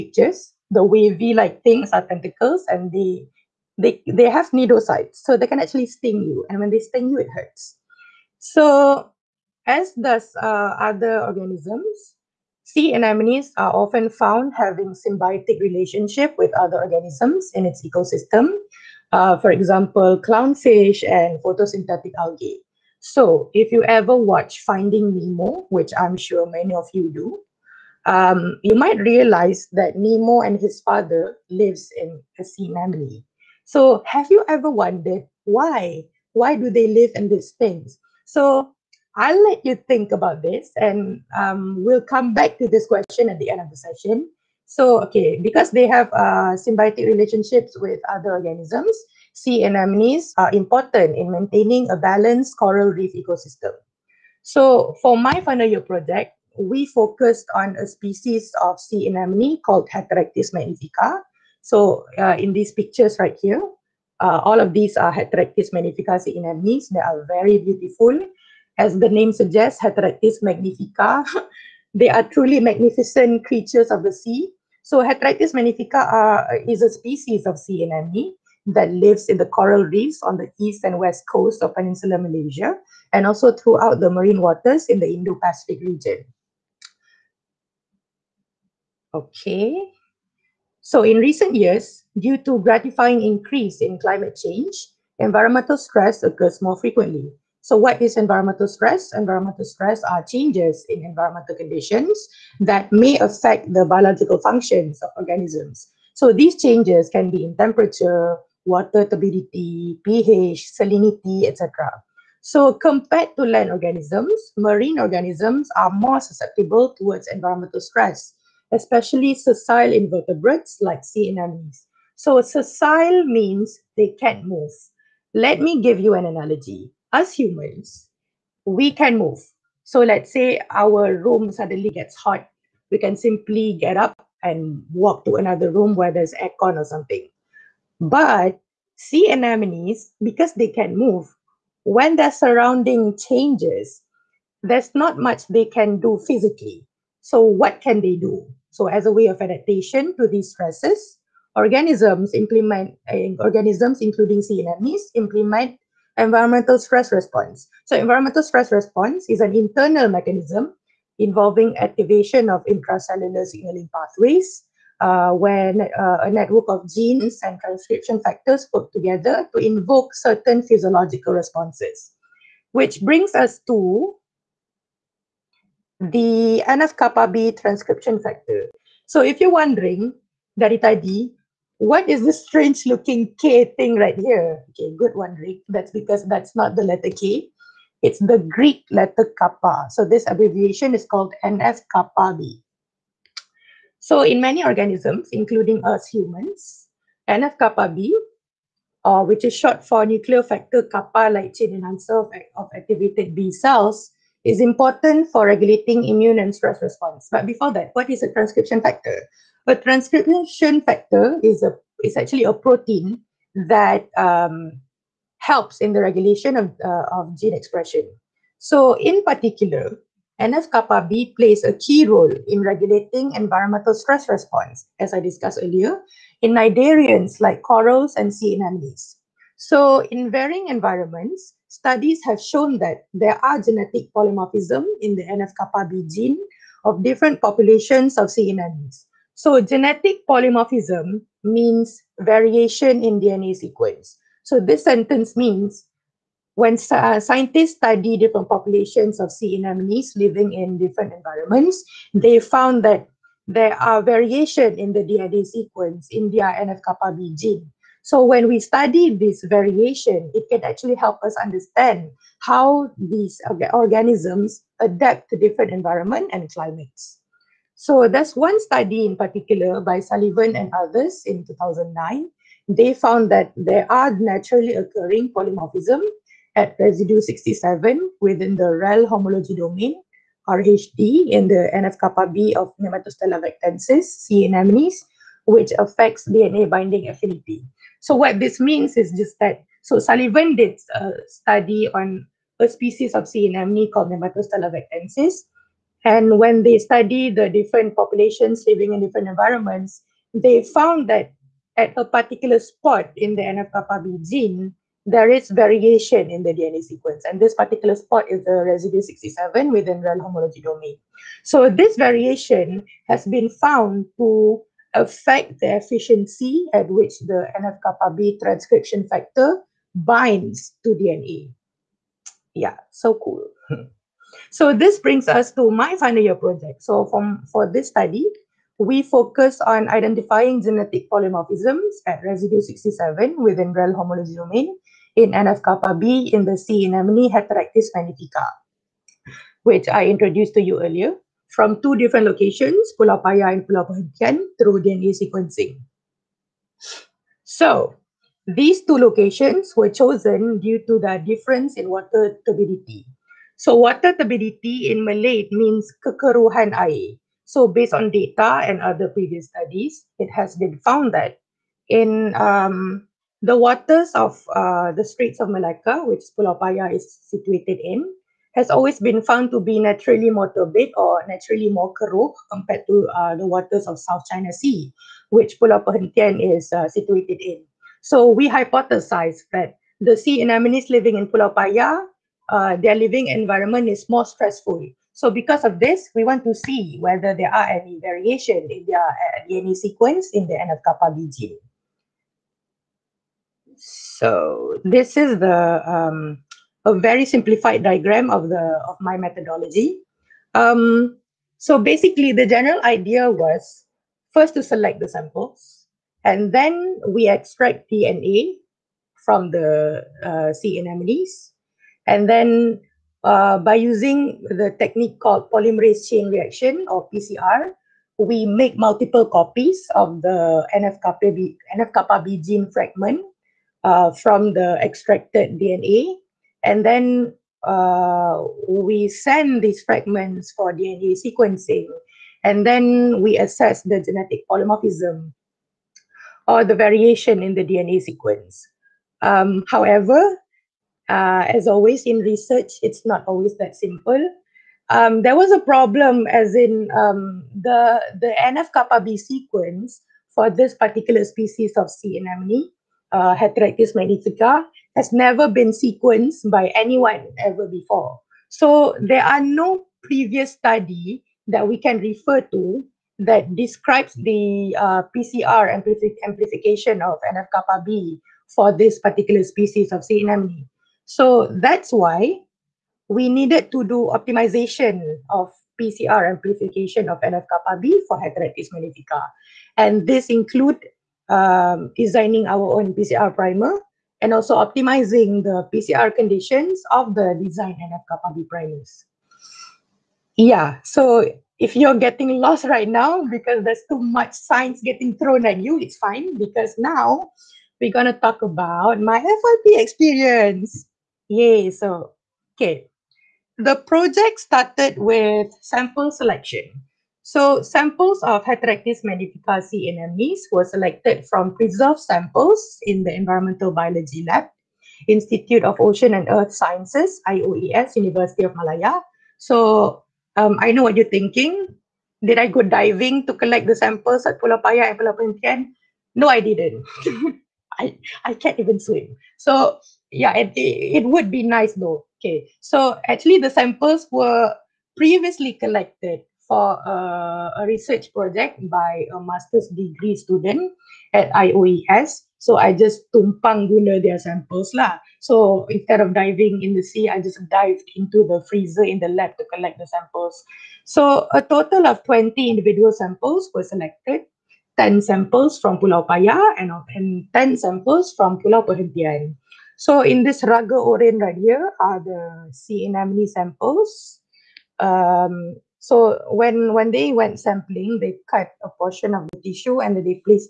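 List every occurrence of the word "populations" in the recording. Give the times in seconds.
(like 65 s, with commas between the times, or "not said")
237 s, 248 s, 297 s.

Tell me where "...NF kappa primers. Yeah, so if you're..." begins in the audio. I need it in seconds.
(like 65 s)
487 s.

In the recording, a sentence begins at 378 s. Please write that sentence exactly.
So we hypothesize that the sea anemones living in Pulau Paya, uh, their living environment is more stressful.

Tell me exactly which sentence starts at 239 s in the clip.
So genetic polymorphism means variation in DNA sequence.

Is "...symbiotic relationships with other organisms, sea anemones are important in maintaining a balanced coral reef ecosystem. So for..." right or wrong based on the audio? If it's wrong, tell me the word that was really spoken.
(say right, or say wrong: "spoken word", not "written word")
right.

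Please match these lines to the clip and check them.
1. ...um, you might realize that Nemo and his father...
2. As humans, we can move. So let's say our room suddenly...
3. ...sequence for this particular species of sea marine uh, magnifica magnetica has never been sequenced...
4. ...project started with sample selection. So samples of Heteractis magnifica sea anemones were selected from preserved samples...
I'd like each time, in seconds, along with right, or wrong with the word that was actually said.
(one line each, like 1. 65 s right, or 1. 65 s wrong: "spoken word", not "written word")
1. 28 s right
2. 127 s right
3. 449 s wrong: "anemone", not "marine"
4. 503 s right.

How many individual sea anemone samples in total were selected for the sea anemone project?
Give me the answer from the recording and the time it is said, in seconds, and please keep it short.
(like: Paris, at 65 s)
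20, at 552 s.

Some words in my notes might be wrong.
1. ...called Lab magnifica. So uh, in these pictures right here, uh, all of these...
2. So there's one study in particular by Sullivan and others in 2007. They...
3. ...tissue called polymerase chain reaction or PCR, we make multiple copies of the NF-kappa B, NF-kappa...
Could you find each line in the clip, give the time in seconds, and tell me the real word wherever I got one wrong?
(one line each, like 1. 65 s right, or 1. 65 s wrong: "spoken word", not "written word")
1. 59 s wrong: "Heteractis", not "Lab"
2. 267 s wrong: "2009", not "2007"
3. 414 s wrong: "technique", not "tissue".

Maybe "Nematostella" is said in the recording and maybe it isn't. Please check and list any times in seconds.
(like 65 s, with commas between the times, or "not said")
282 s, 294 s.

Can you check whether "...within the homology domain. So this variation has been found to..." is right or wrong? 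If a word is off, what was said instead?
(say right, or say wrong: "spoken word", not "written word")
right.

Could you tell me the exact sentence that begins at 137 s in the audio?
But sea anemones, because they can move, when their surrounding changes, there's not much they can do physically.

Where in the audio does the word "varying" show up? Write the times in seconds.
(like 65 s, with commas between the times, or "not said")
230 s.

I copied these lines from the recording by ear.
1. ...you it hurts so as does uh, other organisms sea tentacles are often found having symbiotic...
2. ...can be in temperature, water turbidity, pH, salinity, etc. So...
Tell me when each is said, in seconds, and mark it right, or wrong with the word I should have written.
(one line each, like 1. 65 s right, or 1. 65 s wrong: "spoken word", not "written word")
1. 7 s wrong: "anemones", not "tentacles"
2. 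107 s right.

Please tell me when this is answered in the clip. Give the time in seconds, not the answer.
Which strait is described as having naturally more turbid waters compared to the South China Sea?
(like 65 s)
365 s.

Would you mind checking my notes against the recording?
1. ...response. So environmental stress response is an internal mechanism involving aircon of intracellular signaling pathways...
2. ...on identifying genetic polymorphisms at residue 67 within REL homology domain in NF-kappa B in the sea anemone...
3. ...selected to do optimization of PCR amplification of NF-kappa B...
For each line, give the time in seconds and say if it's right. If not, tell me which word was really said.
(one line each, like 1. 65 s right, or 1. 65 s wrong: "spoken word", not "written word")
1. 157 s wrong: "activation", not "aircon"
2. 329 s right
3. 473 s wrong: "needed", not "selected".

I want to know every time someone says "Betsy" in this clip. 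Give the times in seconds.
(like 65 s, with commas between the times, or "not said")
not said.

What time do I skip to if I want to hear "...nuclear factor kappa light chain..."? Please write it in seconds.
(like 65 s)
200 s.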